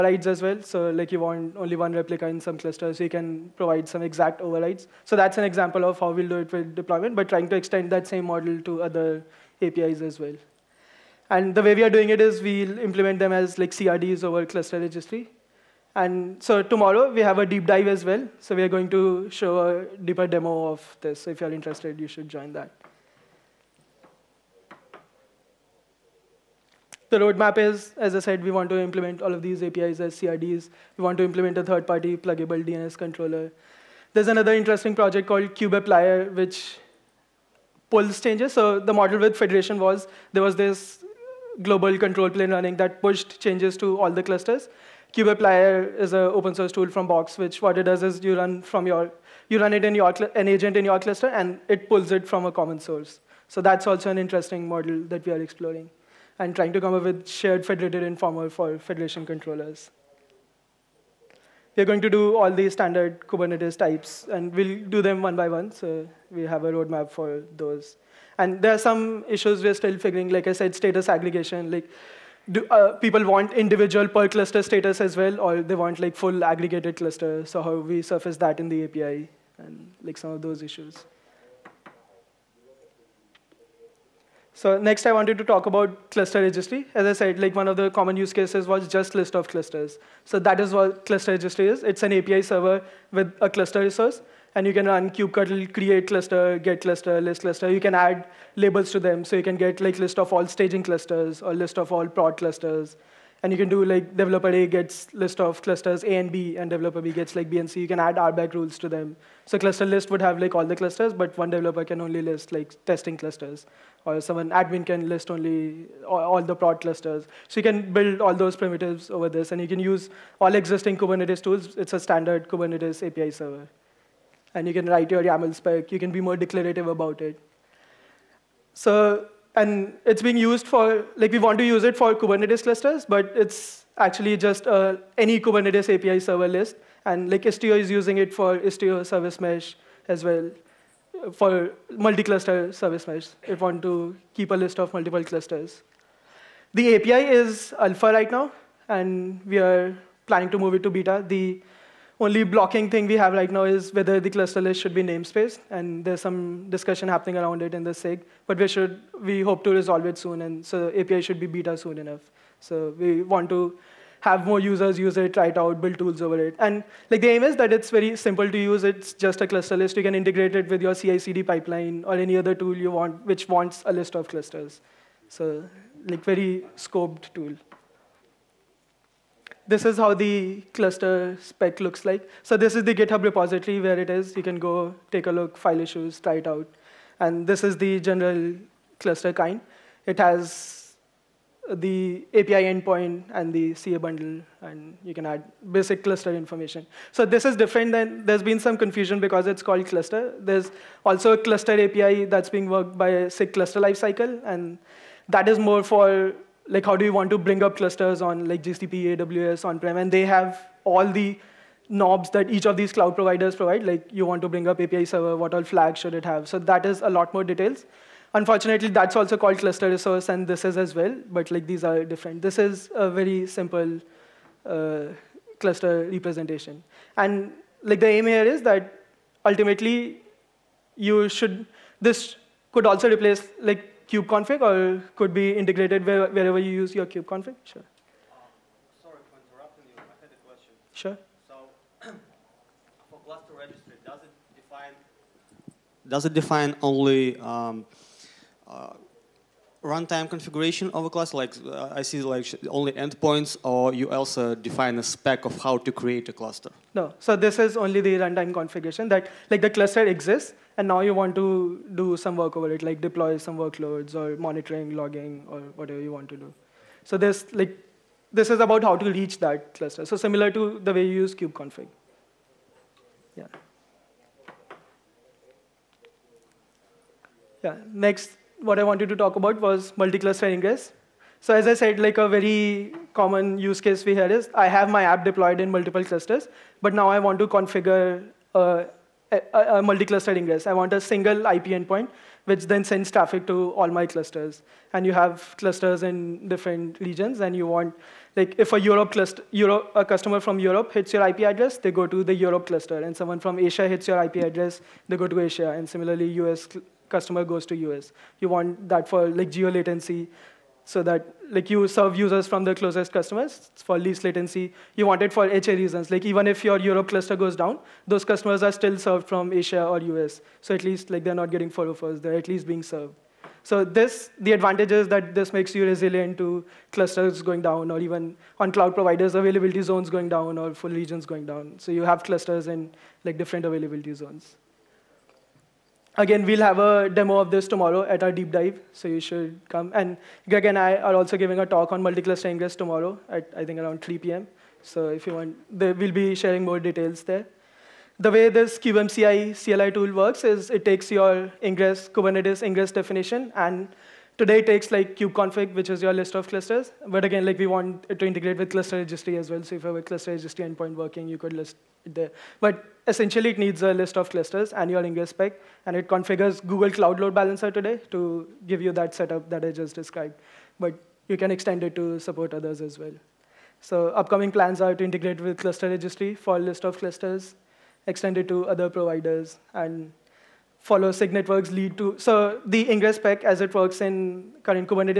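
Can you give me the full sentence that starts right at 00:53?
So that's also an interesting model that we are exploring and trying to come up with shared federated informer for federation controllers.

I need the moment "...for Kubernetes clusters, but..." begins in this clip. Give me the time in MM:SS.
02:11.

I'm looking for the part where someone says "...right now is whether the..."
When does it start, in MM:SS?
02:33.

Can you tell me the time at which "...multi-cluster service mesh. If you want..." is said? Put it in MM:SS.
02:21.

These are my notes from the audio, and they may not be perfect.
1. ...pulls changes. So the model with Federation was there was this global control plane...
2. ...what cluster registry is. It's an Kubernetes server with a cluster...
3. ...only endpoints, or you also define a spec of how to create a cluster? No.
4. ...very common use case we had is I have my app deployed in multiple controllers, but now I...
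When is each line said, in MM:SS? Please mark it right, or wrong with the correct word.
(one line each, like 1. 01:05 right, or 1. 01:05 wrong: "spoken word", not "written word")
1. 00:37 right
2. 01:30 wrong: "API", not "Kubernetes"
3. 04:12 right
4. 04:42 wrong: "clusters", not "controllers".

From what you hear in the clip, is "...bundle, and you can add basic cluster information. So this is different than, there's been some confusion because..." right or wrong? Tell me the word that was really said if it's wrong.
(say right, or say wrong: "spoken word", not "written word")
right.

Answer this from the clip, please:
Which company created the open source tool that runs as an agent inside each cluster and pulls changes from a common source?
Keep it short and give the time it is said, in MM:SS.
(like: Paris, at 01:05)
Box, at 00:47.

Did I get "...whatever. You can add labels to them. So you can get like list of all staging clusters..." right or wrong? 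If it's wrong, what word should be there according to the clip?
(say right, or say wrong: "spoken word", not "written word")
wrong: "cluster", not "whatever".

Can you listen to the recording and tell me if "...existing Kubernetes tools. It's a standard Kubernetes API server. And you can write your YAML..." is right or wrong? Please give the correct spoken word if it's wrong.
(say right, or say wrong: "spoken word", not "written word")
right.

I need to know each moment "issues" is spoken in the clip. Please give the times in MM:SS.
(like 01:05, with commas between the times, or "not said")
01:09, 01:20, 03:05.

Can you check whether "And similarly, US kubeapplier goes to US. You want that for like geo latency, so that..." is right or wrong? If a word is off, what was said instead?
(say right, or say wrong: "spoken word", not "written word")
wrong: "customer", not "kubeapplier".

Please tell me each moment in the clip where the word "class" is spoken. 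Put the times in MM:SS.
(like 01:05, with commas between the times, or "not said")
04:11.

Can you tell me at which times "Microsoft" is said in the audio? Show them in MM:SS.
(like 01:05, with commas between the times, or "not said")
not said.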